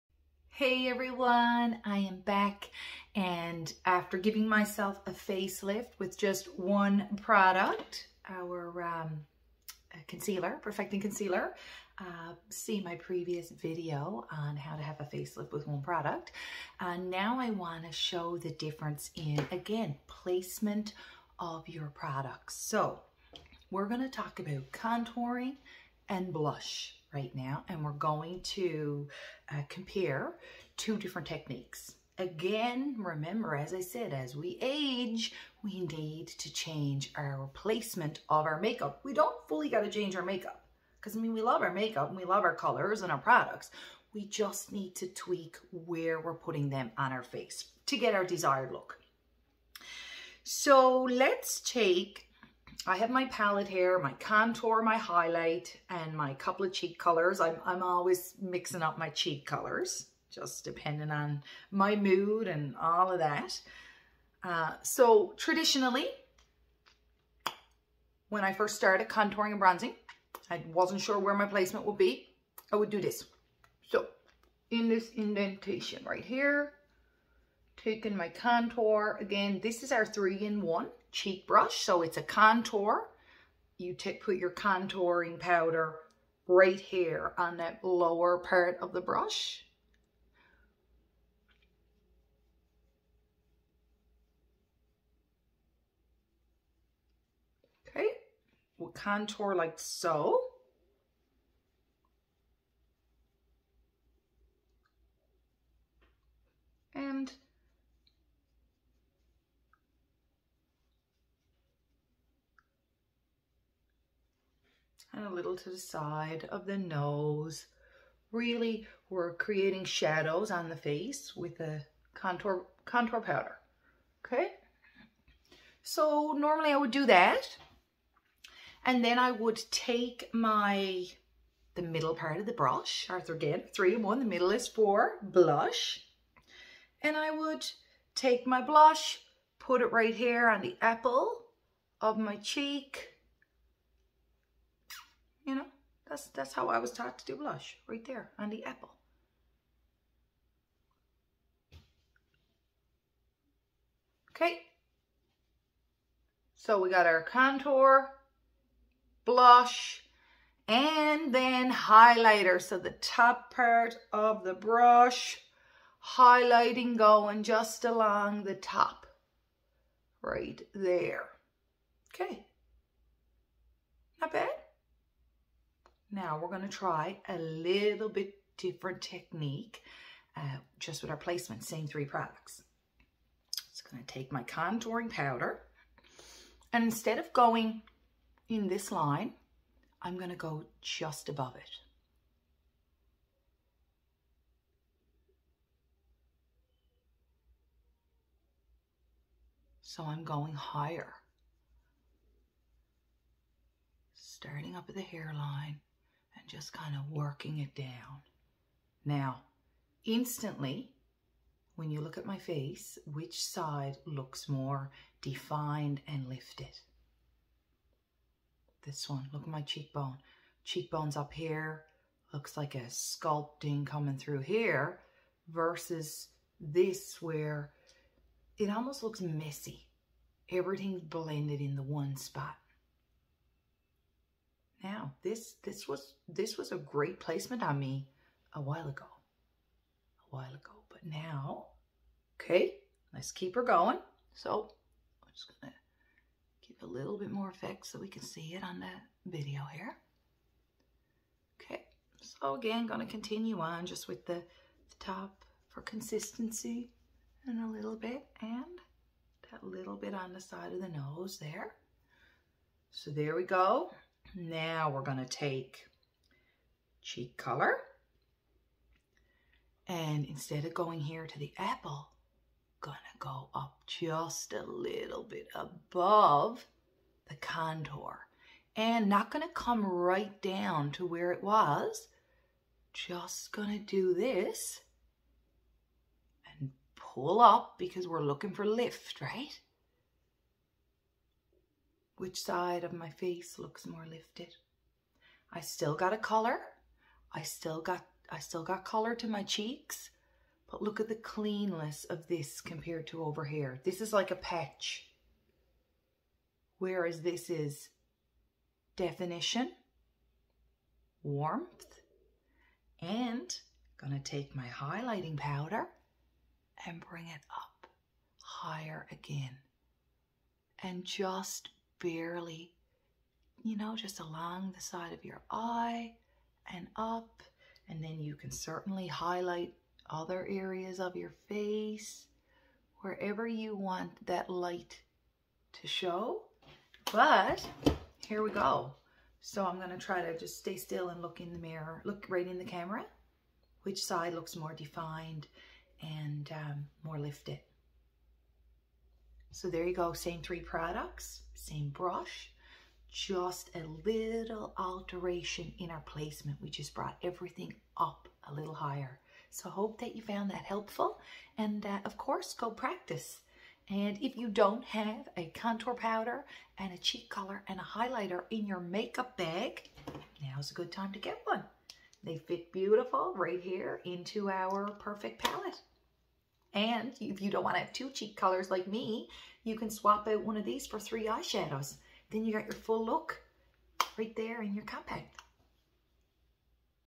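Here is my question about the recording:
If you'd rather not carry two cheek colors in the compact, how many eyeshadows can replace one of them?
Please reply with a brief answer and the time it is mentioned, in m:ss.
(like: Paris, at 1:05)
3, at 6:20.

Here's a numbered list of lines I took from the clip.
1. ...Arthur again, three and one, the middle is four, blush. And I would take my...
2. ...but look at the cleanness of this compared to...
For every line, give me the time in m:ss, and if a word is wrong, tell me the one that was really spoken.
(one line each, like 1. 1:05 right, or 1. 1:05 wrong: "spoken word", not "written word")
1. 2:13 right
2. 5:00 right.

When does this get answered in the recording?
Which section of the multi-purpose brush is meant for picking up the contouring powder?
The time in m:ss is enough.
1:27.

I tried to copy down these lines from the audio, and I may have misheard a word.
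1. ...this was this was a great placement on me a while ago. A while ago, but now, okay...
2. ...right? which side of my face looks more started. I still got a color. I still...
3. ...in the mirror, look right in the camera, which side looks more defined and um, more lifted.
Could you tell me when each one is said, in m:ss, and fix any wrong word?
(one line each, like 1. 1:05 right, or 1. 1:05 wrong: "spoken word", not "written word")
1. 3:55 right
2. 4:49 wrong: "lifted", not "started"
3. 5:41 right.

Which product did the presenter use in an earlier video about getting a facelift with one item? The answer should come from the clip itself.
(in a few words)
Perfecting Concealer.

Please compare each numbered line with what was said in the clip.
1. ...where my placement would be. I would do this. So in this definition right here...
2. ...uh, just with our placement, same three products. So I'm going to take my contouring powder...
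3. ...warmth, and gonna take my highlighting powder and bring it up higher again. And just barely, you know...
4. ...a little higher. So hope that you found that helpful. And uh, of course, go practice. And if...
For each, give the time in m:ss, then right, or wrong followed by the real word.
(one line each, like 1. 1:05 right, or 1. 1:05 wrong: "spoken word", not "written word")
1. 1:11 wrong: "indentation", not "definition"
2. 3:00 right
3. 5:11 right
4. 5:58 right.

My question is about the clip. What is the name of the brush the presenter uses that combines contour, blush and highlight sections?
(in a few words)
three in one cheek brush.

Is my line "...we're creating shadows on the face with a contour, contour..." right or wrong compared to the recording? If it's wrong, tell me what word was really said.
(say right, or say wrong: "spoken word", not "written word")
right.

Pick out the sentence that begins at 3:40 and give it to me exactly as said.
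Cheekbones up here, looks like a sculpting coming through here versus this where it almost looks messy.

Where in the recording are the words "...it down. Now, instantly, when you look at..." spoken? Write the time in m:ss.
3:27.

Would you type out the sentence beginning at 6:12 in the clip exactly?
They fit beautiful right here into our perfect palette.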